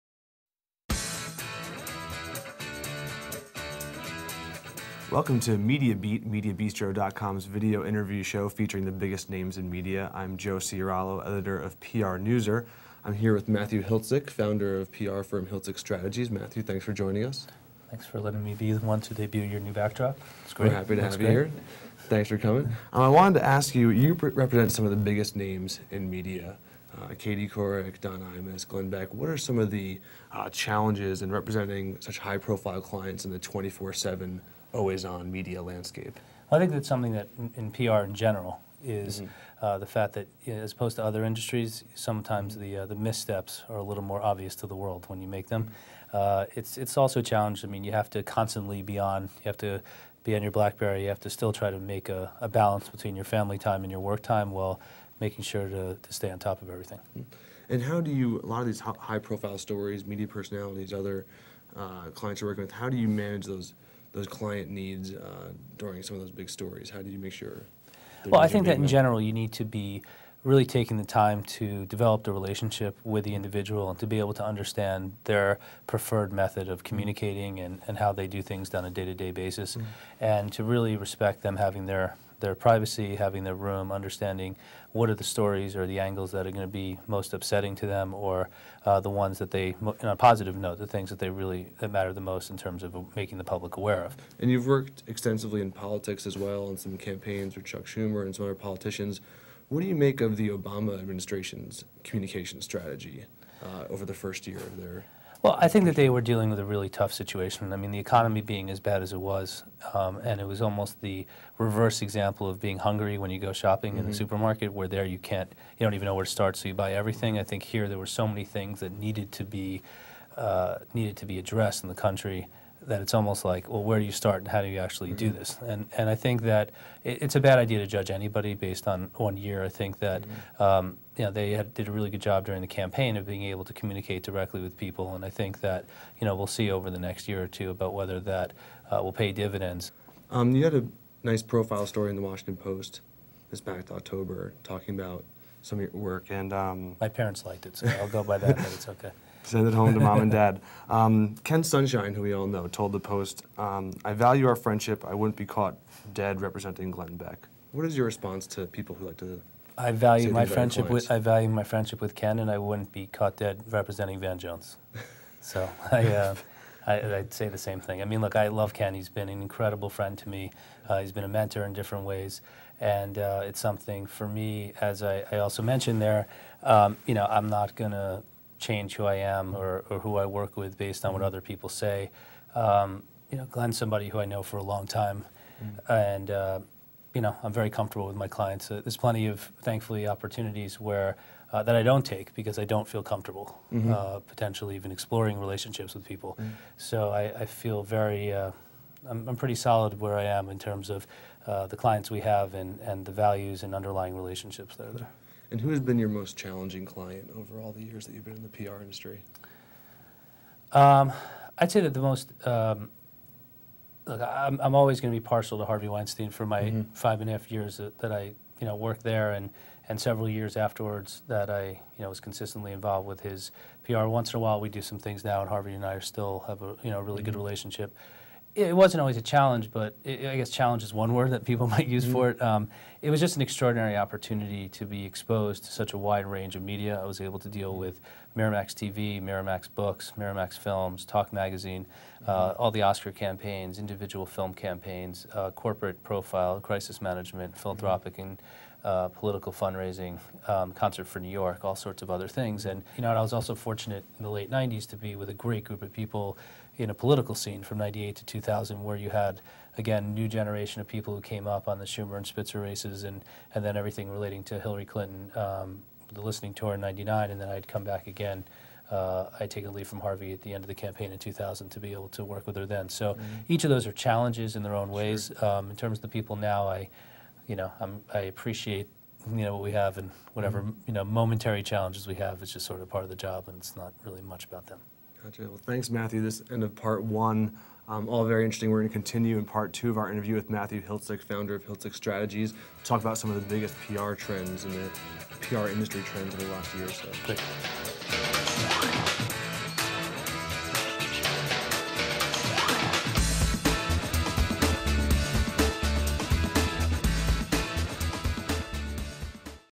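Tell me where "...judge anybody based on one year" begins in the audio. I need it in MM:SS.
02:07.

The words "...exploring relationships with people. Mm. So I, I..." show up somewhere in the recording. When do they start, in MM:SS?
03:14.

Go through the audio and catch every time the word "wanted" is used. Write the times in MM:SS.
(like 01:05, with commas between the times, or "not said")
00:23.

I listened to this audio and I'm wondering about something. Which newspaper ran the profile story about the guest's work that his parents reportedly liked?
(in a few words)
Washington Post.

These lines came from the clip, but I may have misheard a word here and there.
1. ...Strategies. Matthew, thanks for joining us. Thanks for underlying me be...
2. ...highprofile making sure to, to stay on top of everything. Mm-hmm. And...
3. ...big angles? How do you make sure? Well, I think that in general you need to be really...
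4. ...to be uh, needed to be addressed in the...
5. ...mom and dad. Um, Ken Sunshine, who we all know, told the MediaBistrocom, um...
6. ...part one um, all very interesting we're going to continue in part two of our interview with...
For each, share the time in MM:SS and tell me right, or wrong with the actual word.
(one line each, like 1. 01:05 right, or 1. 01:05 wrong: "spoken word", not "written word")
1. 00:15 wrong: "letting", not "underlying"
2. 00:54 wrong: "while", not "highprofile"
3. 01:06 wrong: "stories", not "angles"
4. 01:59 right
5. 02:29 wrong: "Post", not "MediaBistrocom"
6. 04:46 right.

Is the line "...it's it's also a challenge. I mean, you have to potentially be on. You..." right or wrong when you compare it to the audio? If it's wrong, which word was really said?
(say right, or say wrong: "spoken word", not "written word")
wrong: "constantly", not "potentially".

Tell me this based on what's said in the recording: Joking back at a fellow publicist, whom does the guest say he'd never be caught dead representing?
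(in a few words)
Van Jones.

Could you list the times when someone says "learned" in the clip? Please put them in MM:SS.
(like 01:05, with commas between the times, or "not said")
not said.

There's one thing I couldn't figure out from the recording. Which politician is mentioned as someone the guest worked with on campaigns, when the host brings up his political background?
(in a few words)
Chuck Schumer.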